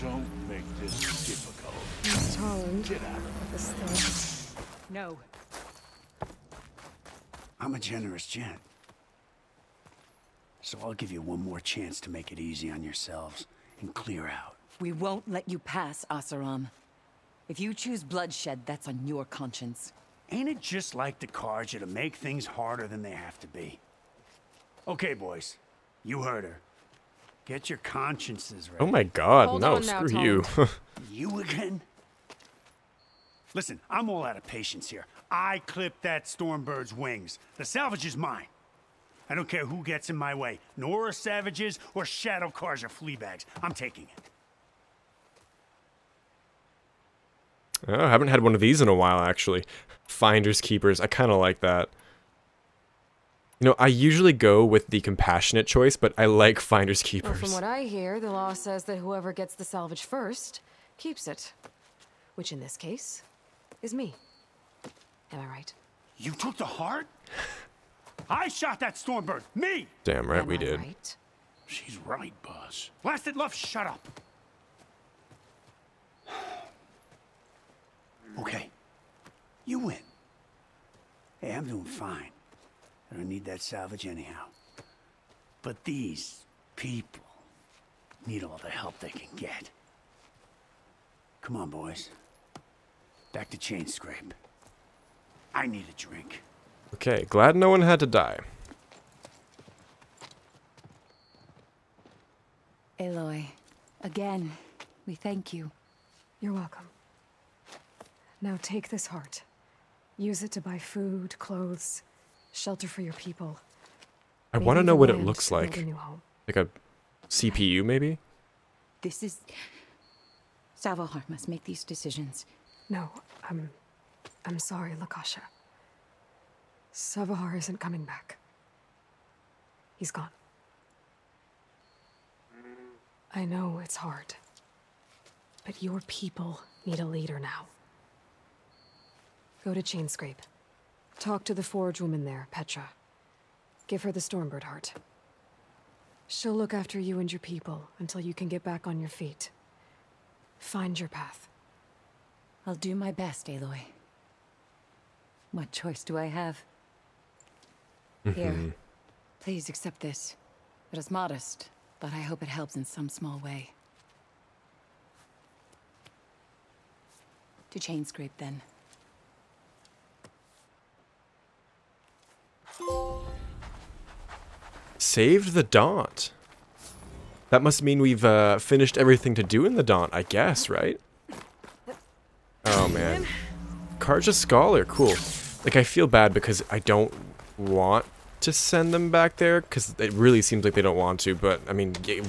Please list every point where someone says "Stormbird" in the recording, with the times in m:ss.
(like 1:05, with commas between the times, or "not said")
0:36, 1:08, 2:24.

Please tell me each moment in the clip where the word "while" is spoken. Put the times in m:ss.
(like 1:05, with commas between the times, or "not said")
0:48.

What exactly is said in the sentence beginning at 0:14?
We won't let you pass, Oseram.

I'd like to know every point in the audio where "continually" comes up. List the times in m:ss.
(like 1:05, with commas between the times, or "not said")
not said.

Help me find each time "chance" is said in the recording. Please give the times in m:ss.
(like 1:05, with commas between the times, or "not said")
0:11.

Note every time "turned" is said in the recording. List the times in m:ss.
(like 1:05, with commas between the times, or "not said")
not said.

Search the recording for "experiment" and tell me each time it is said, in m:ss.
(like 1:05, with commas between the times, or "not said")
not said.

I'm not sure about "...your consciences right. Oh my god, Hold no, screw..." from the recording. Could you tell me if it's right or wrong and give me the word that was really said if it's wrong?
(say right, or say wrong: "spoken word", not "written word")
right.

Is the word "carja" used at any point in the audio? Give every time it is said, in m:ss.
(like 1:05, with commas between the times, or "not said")
0:21, 0:42, 3:03.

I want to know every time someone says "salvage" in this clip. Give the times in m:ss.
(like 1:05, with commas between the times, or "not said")
0:37, 0:59, 1:23.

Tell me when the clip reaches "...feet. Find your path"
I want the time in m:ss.
2:29.